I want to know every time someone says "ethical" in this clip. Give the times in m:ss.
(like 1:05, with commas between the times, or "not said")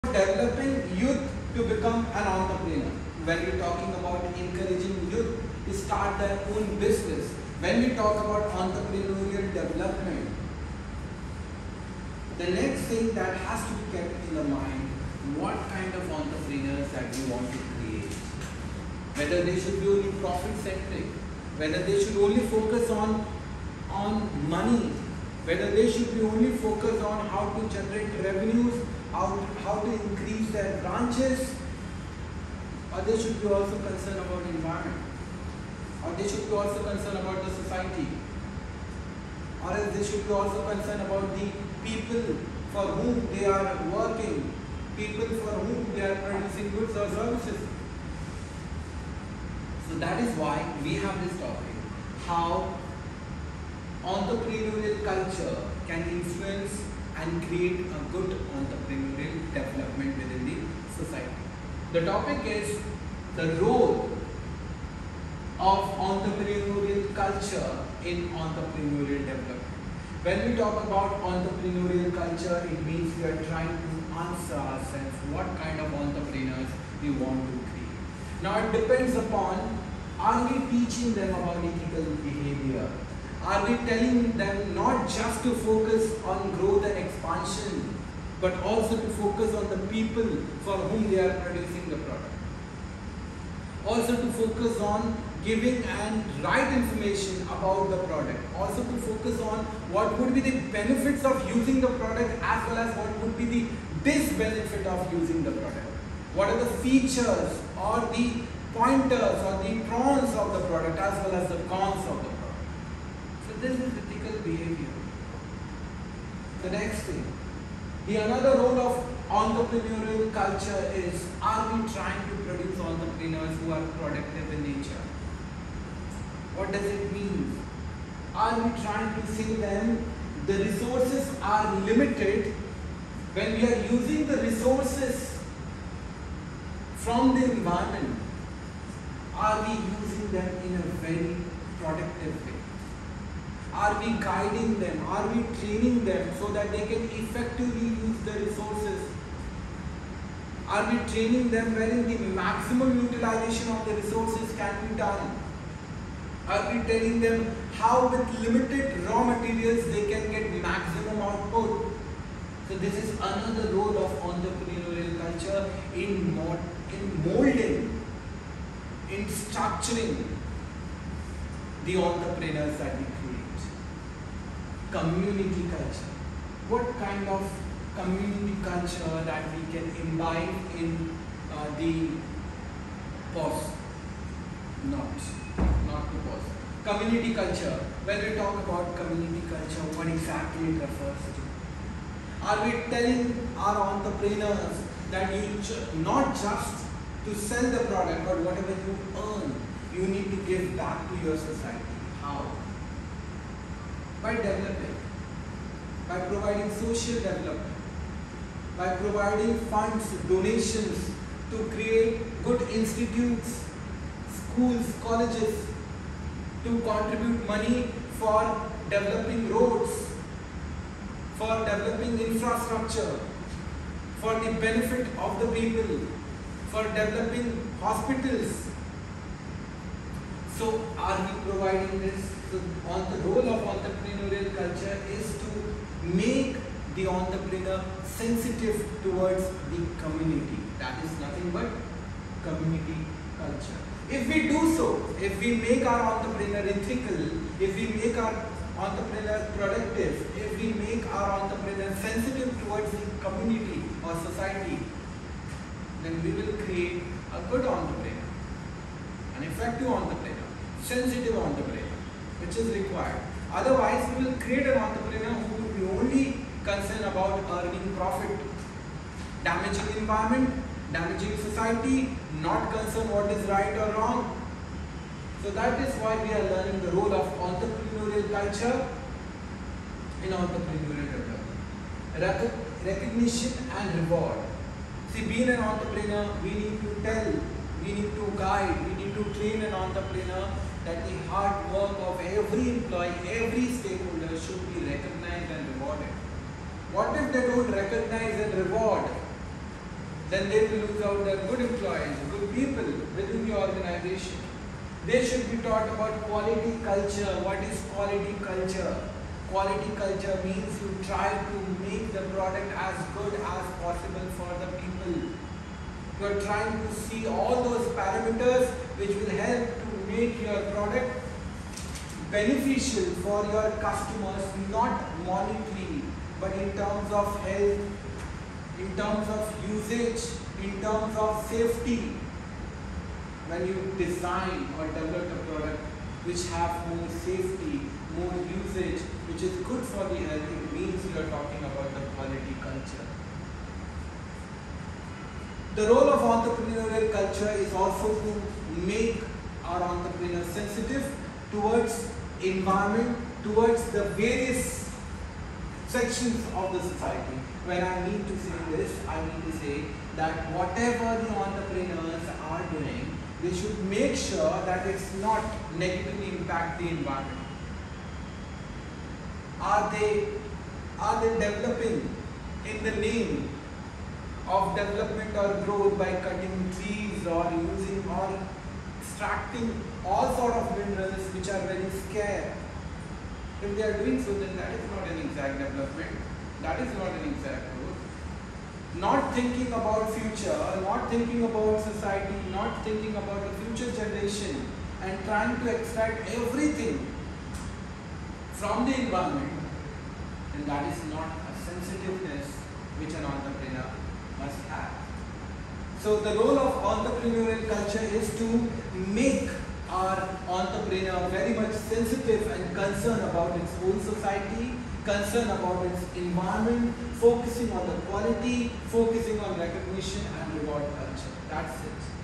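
1:21, 1:53, 4:06.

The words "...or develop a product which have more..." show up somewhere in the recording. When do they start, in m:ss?
5:34.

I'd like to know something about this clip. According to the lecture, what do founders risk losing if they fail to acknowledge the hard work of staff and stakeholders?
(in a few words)
Good employees.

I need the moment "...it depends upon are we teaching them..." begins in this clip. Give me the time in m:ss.
1:18.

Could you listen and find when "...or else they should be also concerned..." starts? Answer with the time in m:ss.
0:39.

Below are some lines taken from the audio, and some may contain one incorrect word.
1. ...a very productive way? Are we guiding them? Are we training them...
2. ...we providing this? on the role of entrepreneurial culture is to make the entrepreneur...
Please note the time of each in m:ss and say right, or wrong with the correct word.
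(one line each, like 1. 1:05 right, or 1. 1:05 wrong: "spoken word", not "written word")
1. 2:20 right
2. 3:51 right.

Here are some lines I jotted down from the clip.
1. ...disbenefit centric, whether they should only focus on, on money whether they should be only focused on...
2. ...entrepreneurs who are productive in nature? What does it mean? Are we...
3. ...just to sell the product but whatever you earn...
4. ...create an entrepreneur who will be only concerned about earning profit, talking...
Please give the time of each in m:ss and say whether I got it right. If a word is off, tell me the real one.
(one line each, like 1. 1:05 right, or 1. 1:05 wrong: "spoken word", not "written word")
1. 0:20 wrong: "profit", not "disbenefit"
2. 2:02 right
3. 3:16 right
4. 4:24 wrong: "damaging", not "talking".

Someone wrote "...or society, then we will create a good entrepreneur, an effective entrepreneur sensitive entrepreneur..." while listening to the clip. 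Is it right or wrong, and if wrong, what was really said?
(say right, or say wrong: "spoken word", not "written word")
right.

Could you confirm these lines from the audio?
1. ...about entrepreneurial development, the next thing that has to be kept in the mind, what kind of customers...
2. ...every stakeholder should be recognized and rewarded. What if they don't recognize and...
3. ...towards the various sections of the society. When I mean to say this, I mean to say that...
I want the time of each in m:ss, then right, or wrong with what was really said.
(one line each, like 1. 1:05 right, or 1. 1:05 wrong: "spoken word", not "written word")
1. 0:08 wrong: "entrepreneurs", not "customers"
2. 4:53 right
3. 5:53 right.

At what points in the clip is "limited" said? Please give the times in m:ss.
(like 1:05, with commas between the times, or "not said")
2:11, 2:38.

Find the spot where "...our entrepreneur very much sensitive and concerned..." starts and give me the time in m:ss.
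6:49.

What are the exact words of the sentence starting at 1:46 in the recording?
What are the features or the pointers or the pros of the product as well as the cons of the product.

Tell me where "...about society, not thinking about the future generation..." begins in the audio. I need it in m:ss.
6:31.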